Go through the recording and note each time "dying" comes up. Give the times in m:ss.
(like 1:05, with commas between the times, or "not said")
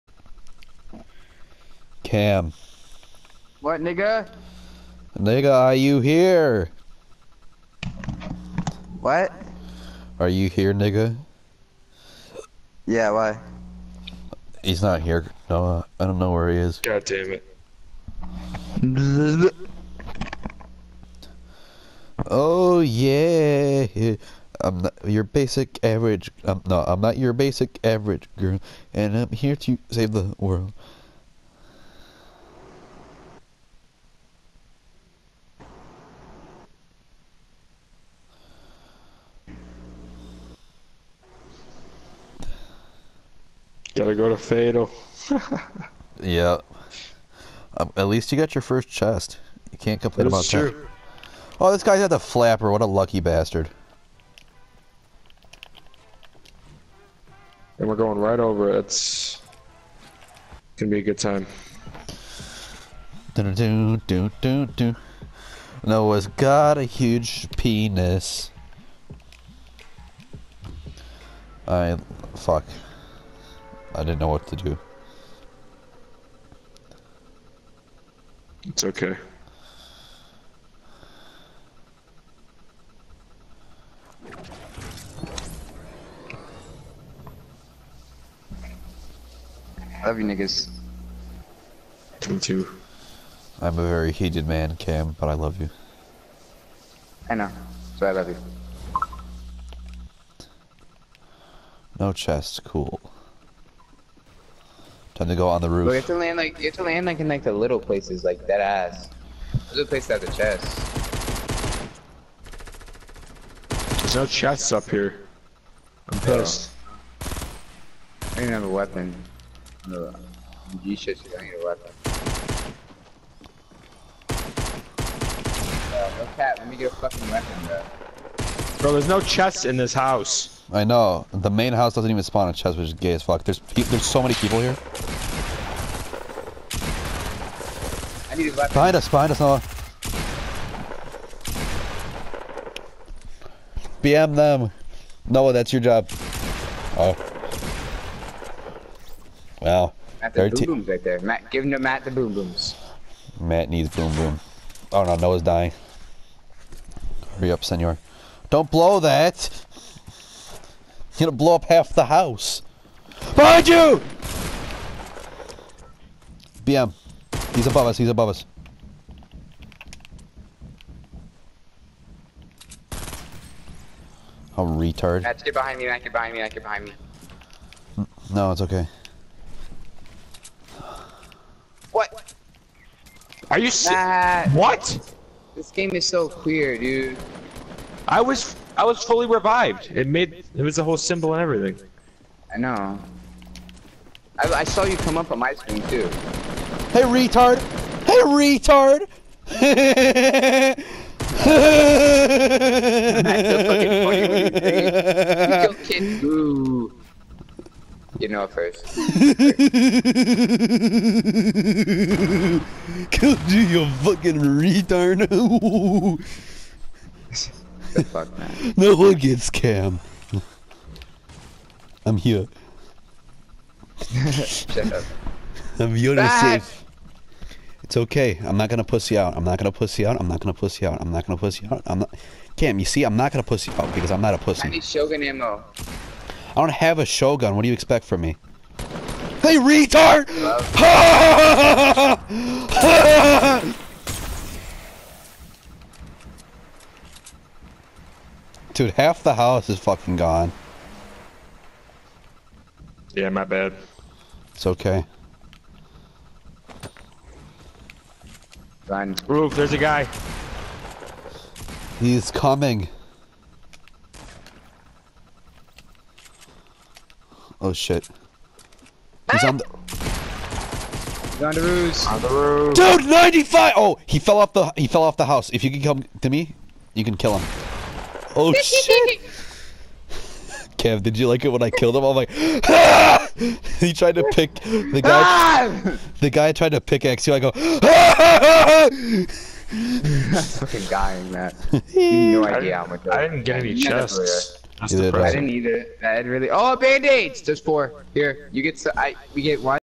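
2:35, 4:50.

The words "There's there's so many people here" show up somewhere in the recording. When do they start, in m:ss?
2:13.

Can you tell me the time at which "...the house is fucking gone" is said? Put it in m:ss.
4:09.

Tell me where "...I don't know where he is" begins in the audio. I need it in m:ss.
0:16.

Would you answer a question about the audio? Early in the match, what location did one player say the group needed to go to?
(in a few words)
Fatal.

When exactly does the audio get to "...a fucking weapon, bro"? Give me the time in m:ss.
2:06.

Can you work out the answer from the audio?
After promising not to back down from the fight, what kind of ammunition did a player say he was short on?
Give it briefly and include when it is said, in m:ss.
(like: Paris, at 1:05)
Shotgun ammo, at 3:54.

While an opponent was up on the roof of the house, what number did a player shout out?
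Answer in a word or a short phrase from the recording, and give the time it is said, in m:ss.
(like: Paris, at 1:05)
95, at 4:33.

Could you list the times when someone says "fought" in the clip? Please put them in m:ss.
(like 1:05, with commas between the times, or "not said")
not said.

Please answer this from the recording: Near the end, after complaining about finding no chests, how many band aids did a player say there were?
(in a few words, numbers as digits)
4.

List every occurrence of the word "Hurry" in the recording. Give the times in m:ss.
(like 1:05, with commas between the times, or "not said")
2:37.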